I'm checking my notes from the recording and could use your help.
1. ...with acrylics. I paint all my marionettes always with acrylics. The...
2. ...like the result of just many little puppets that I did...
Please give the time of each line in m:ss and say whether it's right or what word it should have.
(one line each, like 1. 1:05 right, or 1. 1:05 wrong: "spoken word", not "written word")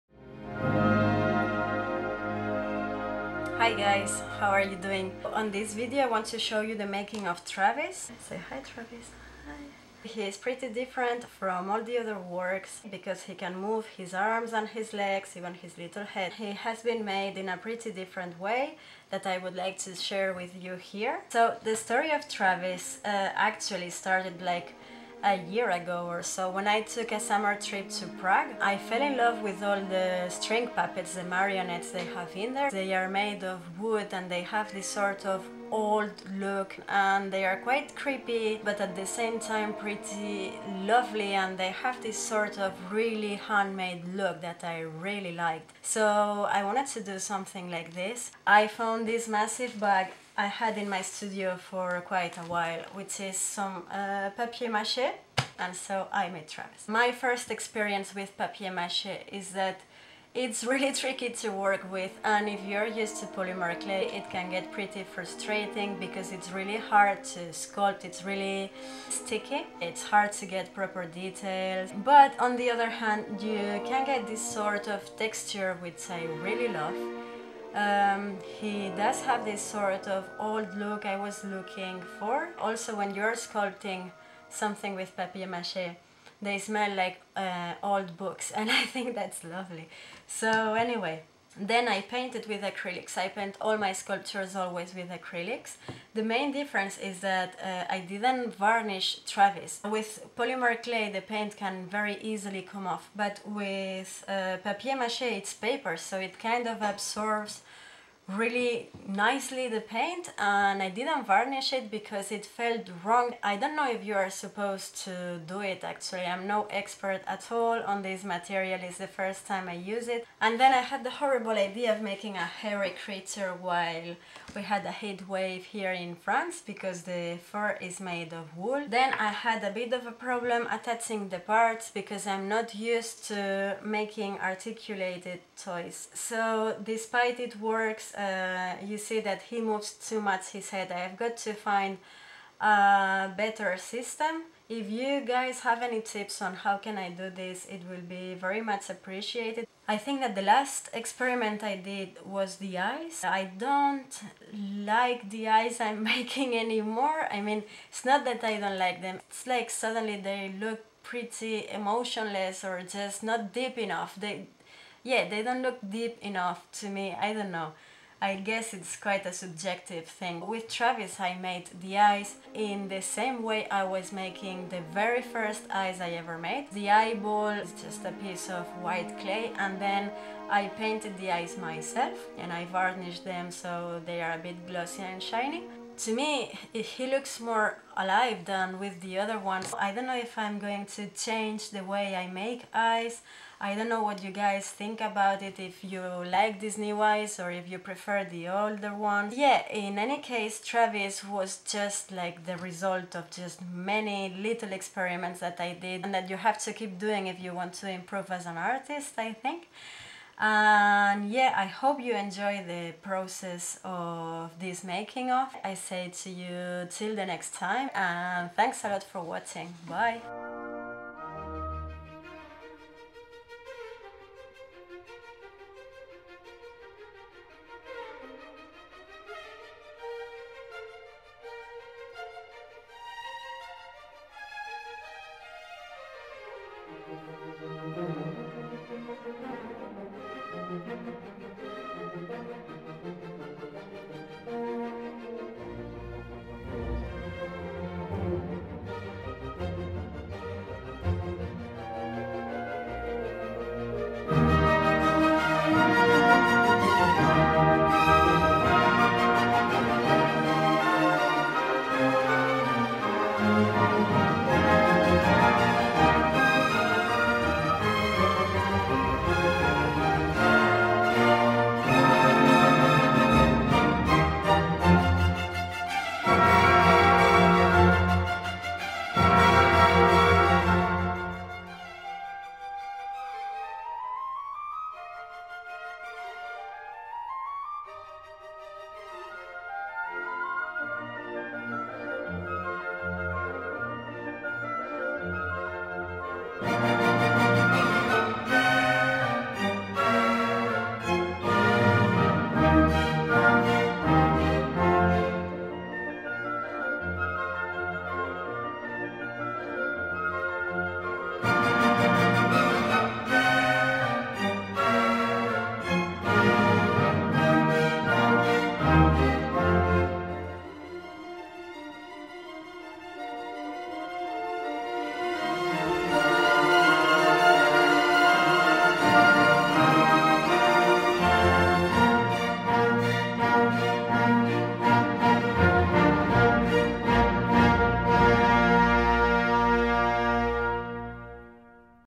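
1. 1:32 wrong: "sculptures", not "marionettes"
2. 3:22 wrong: "experiments", not "puppets".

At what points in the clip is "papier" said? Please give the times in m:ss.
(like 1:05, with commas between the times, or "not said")
0:54, 0:58, 1:25, 1:44.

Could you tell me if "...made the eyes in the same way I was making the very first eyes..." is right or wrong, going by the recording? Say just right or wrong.
right.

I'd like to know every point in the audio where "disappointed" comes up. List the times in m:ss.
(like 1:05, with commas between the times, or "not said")
not said.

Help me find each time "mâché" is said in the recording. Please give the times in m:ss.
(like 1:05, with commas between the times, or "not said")
0:54, 0:58, 1:25, 1:44.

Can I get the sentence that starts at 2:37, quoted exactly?
I mean, it's not that I don't like them.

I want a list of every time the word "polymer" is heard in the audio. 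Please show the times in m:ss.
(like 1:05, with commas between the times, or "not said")
1:03, 1:40.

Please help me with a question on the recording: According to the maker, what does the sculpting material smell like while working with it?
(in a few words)
Old books.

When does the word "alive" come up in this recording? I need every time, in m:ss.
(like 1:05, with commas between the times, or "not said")
3:07.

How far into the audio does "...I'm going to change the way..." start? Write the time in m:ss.
3:10.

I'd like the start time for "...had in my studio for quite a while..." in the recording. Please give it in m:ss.
0:50.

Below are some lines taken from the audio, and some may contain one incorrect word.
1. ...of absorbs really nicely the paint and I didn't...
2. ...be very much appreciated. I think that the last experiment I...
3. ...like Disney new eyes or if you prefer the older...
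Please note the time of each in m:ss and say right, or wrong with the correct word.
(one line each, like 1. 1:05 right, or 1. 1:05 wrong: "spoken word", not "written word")
1. 1:46 right
2. 2:28 right
3. 3:16 right.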